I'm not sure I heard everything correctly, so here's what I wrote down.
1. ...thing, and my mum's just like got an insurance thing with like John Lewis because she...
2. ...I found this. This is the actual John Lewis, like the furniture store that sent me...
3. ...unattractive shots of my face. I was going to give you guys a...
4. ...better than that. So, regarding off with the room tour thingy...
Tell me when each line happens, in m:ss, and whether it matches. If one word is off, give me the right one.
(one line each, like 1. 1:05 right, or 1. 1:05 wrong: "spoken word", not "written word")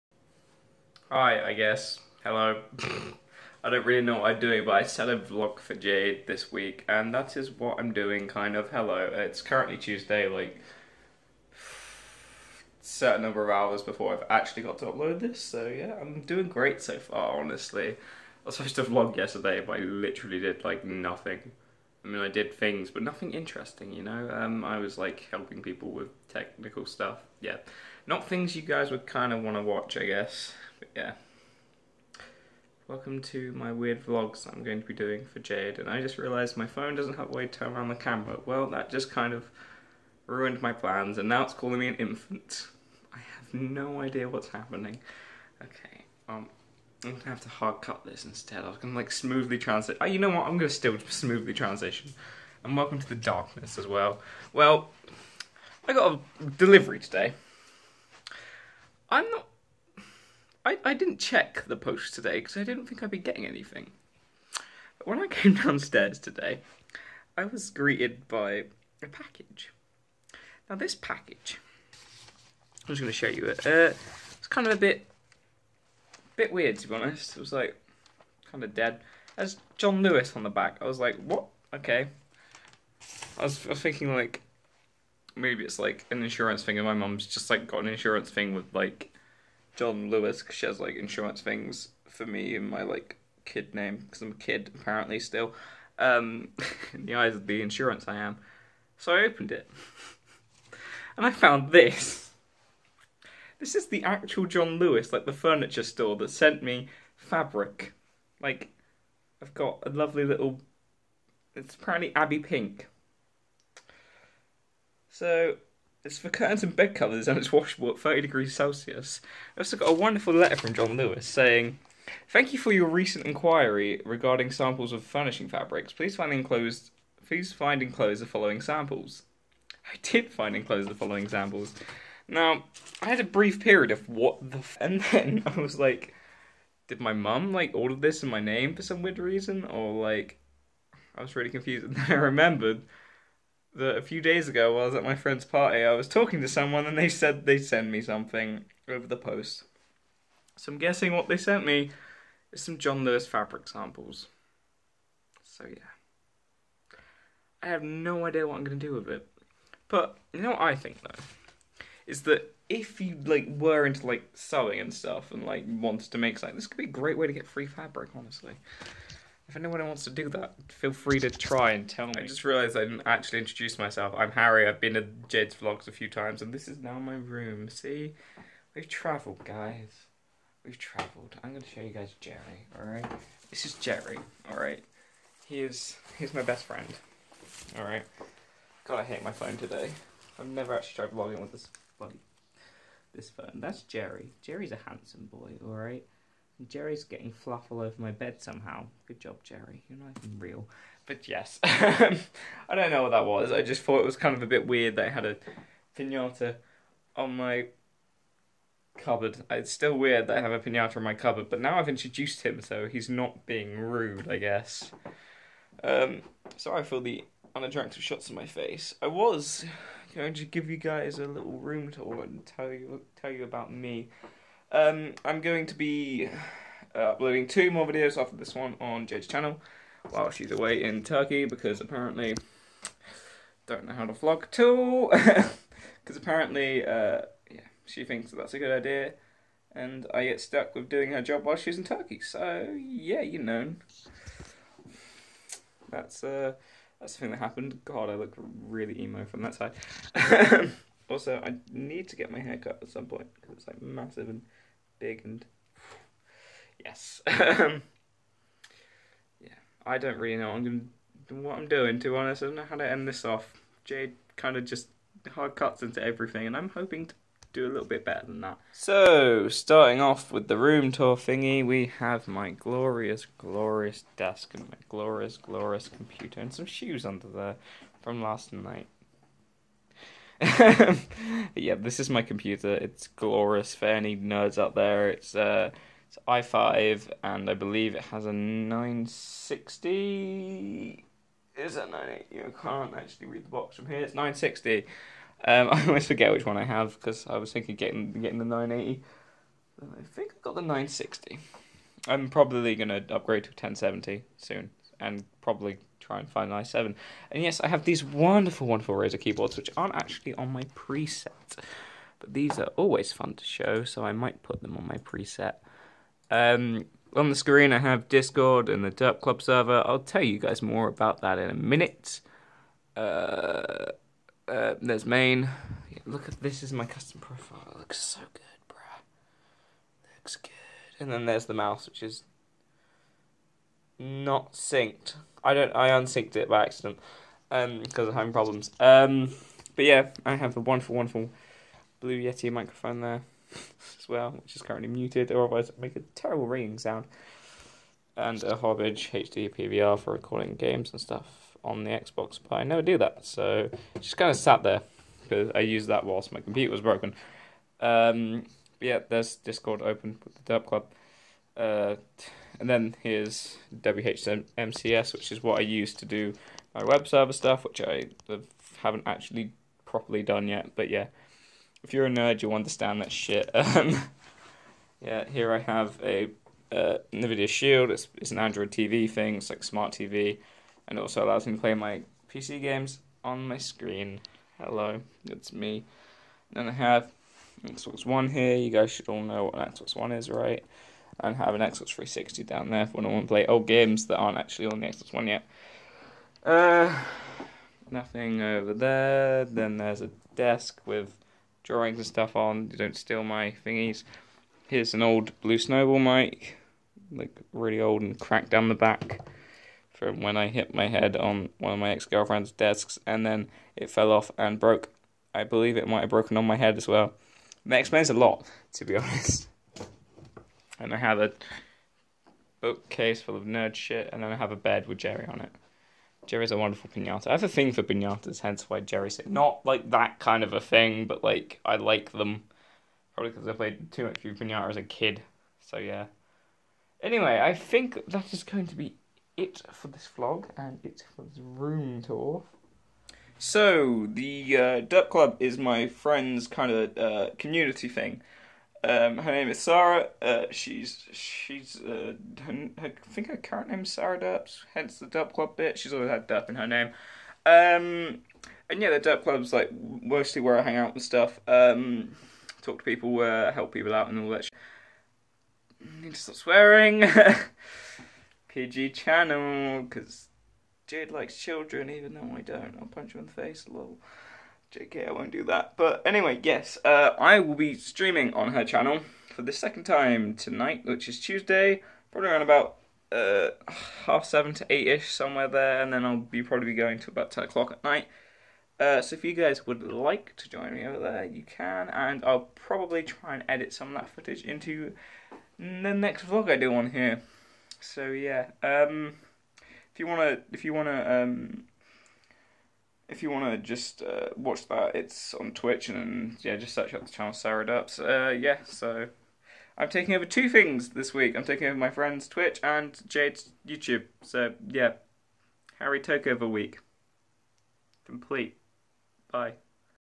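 1. 1:26 right
2. 1:41 right
3. 3:37 right
4. 4:28 wrong: "starting", not "regarding".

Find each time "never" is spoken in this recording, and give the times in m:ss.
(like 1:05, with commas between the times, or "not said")
3:10, 5:52.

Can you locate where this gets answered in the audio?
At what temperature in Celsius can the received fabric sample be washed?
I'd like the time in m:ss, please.
1:57.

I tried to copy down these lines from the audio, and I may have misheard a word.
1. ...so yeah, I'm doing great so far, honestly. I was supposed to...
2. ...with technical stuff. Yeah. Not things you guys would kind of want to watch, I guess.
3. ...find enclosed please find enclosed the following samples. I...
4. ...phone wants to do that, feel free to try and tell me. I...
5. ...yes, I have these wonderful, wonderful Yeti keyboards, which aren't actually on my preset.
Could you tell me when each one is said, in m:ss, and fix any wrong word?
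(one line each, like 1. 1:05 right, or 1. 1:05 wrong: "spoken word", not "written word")
1. 0:15 right
2. 0:25 right
3. 2:06 right
4. 2:49 wrong: "anyone", not "phone"
5. 5:07 wrong: "Razer", not "Yeti".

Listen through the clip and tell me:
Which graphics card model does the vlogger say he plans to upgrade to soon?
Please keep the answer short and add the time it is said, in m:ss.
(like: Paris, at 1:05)
1070, at 5:03.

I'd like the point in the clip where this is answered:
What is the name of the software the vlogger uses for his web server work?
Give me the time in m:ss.
6:03.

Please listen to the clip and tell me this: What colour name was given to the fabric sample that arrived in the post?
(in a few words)
Abby Pink.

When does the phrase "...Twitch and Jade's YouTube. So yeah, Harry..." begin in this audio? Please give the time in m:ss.
8:32.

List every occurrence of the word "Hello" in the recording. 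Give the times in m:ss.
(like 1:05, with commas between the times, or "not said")
0:02, 0:08, 6:24.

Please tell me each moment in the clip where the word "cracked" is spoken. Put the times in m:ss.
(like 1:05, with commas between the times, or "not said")
6:48.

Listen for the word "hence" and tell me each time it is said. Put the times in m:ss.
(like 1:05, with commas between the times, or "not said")
7:08, 7:34.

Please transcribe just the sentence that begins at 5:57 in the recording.
Um, yeah, there's Discord open with the Derp Club.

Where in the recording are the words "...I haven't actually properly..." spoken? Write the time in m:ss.
6:07.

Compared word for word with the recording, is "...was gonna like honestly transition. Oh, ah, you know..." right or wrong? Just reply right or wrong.
wrong.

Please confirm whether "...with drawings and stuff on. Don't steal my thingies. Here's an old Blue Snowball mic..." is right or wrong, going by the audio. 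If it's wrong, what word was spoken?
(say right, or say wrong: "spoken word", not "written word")
right.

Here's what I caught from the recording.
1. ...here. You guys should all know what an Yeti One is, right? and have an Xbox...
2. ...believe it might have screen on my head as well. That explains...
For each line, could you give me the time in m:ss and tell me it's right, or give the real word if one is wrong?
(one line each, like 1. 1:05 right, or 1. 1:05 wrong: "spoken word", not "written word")
1. 6:28 wrong: "Xbox", not "Yeti"
2. 6:55 wrong: "broken", not "screen".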